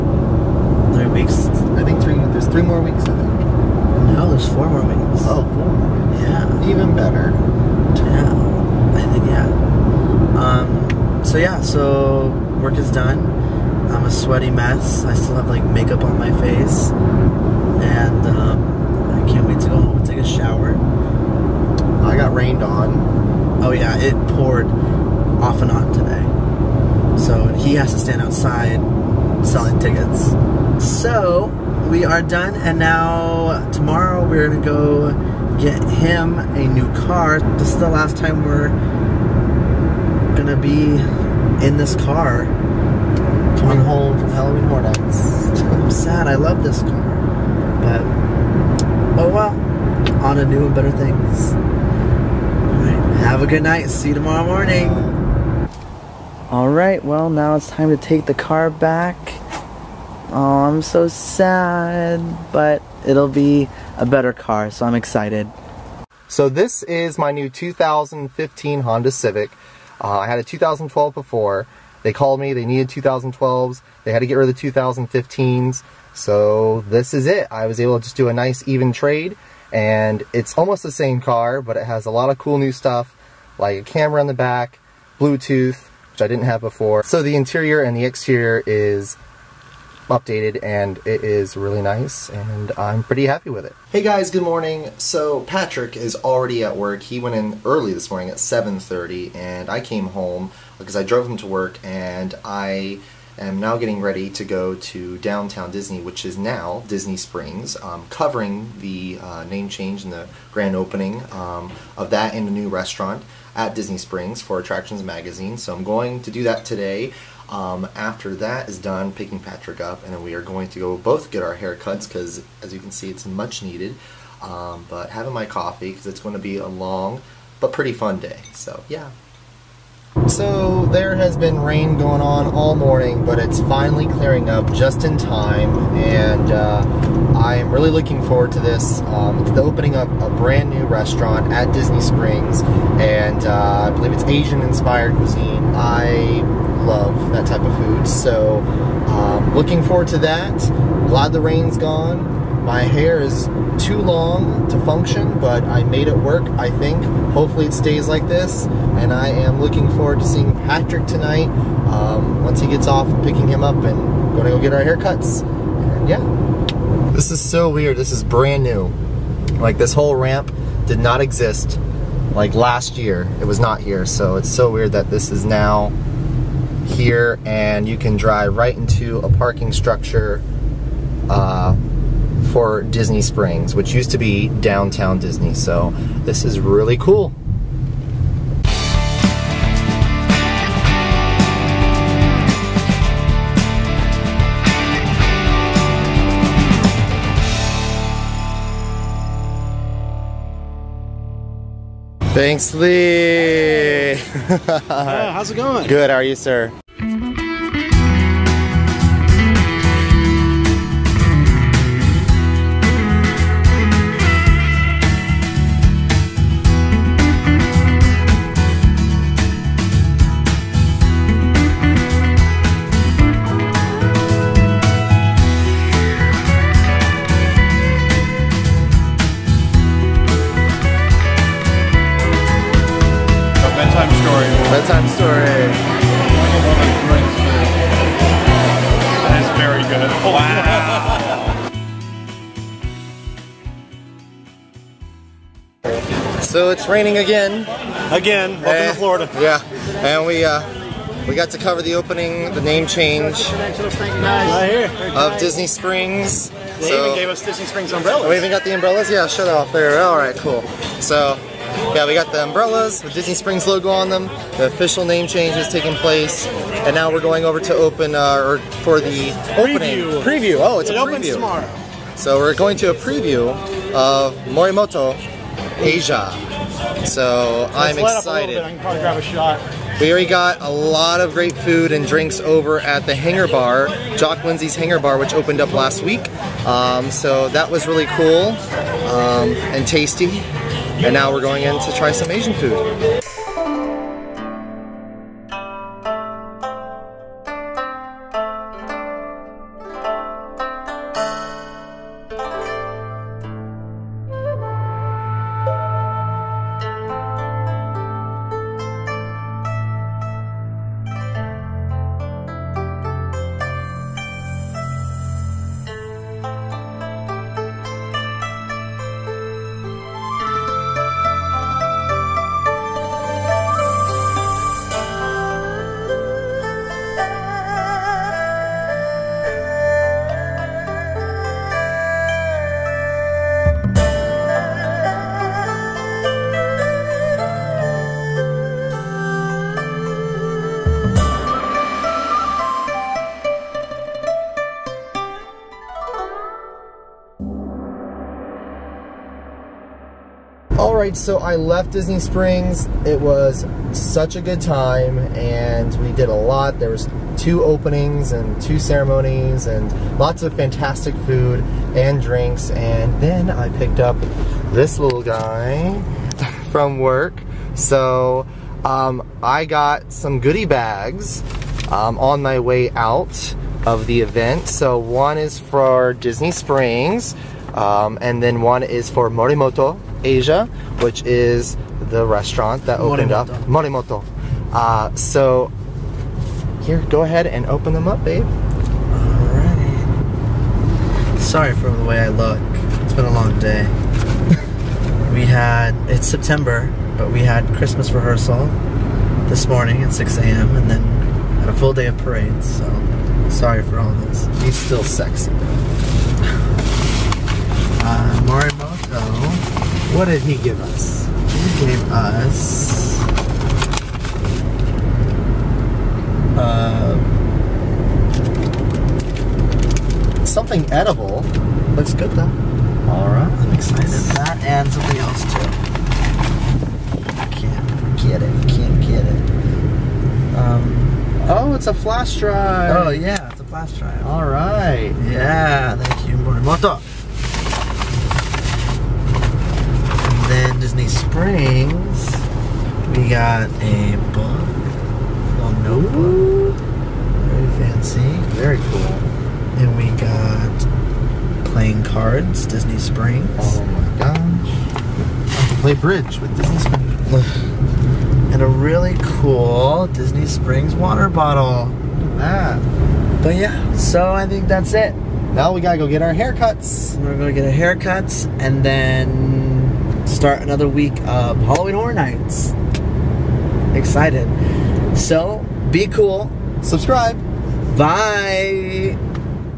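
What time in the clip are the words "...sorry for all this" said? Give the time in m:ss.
6:43.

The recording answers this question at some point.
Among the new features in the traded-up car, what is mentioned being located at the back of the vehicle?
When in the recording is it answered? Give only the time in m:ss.
1:23.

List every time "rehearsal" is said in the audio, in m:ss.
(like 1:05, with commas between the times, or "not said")
6:38.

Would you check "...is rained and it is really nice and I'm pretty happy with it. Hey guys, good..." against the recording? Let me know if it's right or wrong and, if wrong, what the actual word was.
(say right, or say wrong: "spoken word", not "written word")
wrong: "updated", not "rained".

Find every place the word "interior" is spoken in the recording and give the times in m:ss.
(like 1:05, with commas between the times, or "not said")
1:27.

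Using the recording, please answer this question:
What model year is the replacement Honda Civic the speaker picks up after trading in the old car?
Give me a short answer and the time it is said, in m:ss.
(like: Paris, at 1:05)
2015, at 1:07.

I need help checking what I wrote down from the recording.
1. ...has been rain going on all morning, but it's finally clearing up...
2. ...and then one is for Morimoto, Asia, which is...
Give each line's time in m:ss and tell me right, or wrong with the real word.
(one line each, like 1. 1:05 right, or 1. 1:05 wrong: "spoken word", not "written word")
1. 2:11 right
2. 6:18 right.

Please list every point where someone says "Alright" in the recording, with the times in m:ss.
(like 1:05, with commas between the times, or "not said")
0:56, 6:28, 7:03, 7:14.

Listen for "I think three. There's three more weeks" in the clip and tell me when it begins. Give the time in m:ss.
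0:01.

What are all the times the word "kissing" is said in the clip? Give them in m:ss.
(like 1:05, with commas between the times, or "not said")
not said.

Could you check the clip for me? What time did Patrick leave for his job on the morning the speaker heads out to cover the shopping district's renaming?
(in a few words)
7:30.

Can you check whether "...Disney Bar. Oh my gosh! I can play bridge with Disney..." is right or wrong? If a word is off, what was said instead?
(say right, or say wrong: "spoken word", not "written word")
wrong: "Springs", not "Bar".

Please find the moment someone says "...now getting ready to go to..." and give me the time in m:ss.
1:43.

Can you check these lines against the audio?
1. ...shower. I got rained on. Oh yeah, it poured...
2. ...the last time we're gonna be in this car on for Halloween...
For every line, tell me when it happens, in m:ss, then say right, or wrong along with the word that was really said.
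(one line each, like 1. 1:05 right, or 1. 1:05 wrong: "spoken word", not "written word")
1. 0:20 right
2. 0:37 right.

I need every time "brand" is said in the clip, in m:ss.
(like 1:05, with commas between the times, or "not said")
2:20, 2:48.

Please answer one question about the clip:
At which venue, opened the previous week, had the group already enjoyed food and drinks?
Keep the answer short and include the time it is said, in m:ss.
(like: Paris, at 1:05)
Jock Lindsey's Hangar Bar, at 4:44.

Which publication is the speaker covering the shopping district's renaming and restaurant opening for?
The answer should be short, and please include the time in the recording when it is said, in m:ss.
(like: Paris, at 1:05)
Attractions Magazine, at 1:54.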